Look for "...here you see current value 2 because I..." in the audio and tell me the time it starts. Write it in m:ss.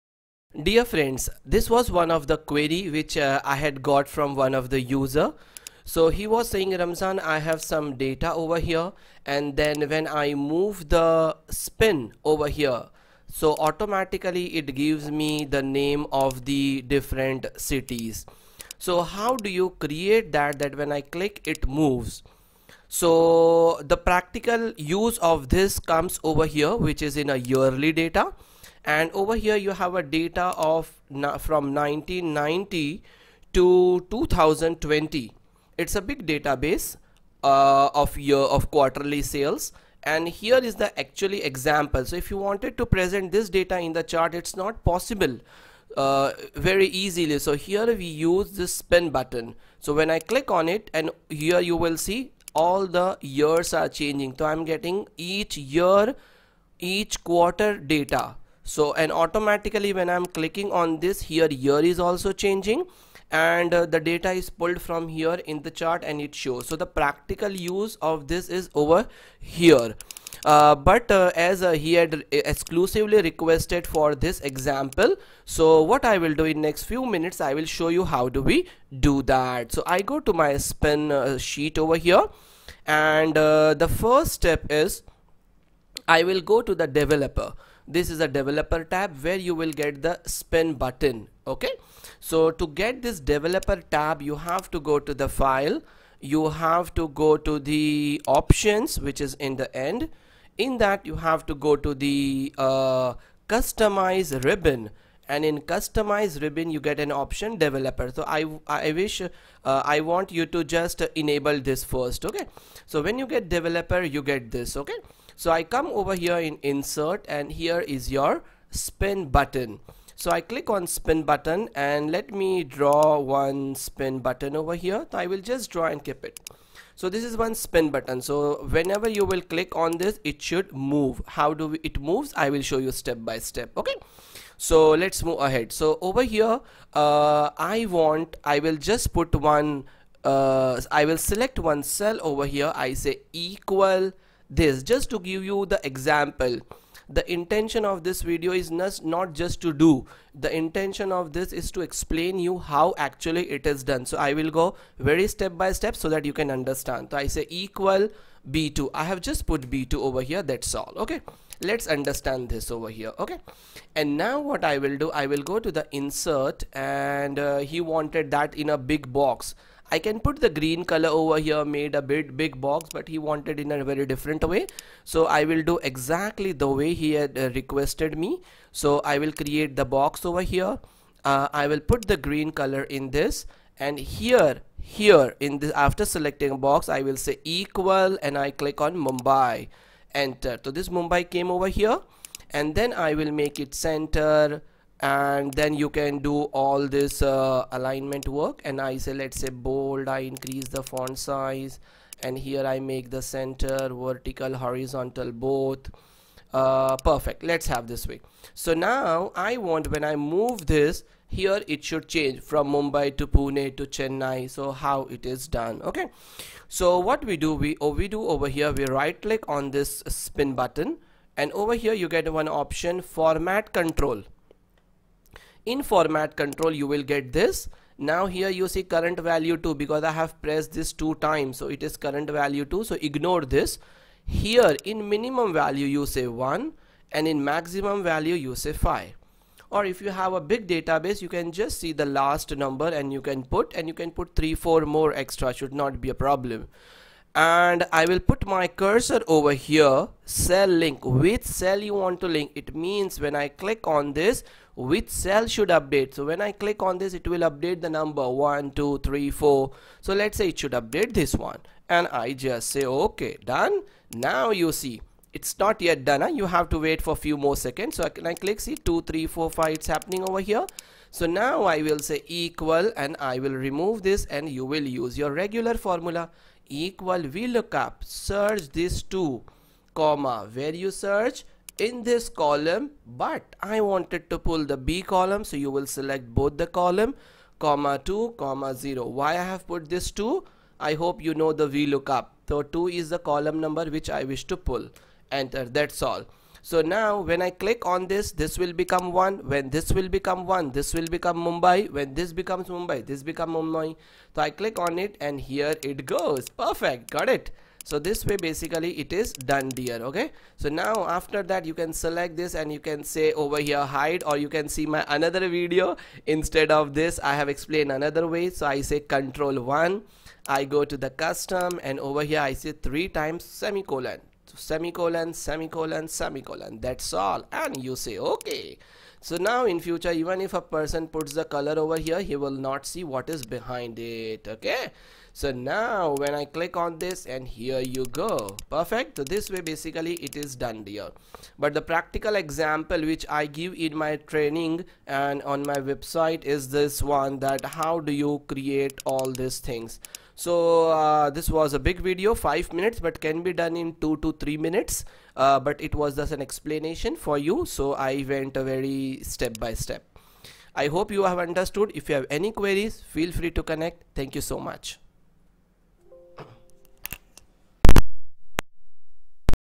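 3:48.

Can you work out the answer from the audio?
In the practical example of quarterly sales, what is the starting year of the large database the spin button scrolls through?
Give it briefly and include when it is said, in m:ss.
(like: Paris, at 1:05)
1990, at 0:31.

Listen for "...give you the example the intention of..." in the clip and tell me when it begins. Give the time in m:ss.
2:25.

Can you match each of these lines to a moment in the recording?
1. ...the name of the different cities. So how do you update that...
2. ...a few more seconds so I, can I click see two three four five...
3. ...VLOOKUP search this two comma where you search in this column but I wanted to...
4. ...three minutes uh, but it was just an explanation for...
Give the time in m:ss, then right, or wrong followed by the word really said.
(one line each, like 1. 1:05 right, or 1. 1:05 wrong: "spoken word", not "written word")
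1. 0:15 wrong: "create", not "update"
2. 4:27 right
3. 4:37 right
4. 5:54 right.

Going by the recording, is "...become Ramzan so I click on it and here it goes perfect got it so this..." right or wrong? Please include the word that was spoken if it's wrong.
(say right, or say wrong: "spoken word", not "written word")
wrong: "Mumbai", not "Ramzan".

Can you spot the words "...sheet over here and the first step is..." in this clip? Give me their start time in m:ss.
1:21.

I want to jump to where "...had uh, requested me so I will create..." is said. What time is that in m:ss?
2:57.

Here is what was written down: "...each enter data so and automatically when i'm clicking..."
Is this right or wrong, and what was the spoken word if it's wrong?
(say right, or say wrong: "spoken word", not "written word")
wrong: "quarter", not "enter".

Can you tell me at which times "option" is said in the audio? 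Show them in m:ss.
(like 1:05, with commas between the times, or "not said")
1:38, 1:47, 3:42.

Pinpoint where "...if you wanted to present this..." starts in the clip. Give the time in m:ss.
0:42.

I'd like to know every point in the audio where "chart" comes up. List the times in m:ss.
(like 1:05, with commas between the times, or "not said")
0:44, 1:05.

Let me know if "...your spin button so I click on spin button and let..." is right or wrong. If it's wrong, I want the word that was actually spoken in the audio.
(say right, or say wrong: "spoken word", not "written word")
right.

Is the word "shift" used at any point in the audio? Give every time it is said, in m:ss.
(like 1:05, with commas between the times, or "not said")
not said.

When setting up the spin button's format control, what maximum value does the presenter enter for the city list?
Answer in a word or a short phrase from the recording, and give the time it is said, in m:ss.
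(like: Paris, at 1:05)
5, at 3:58.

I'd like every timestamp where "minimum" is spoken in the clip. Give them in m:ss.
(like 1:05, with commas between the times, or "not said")
3:55.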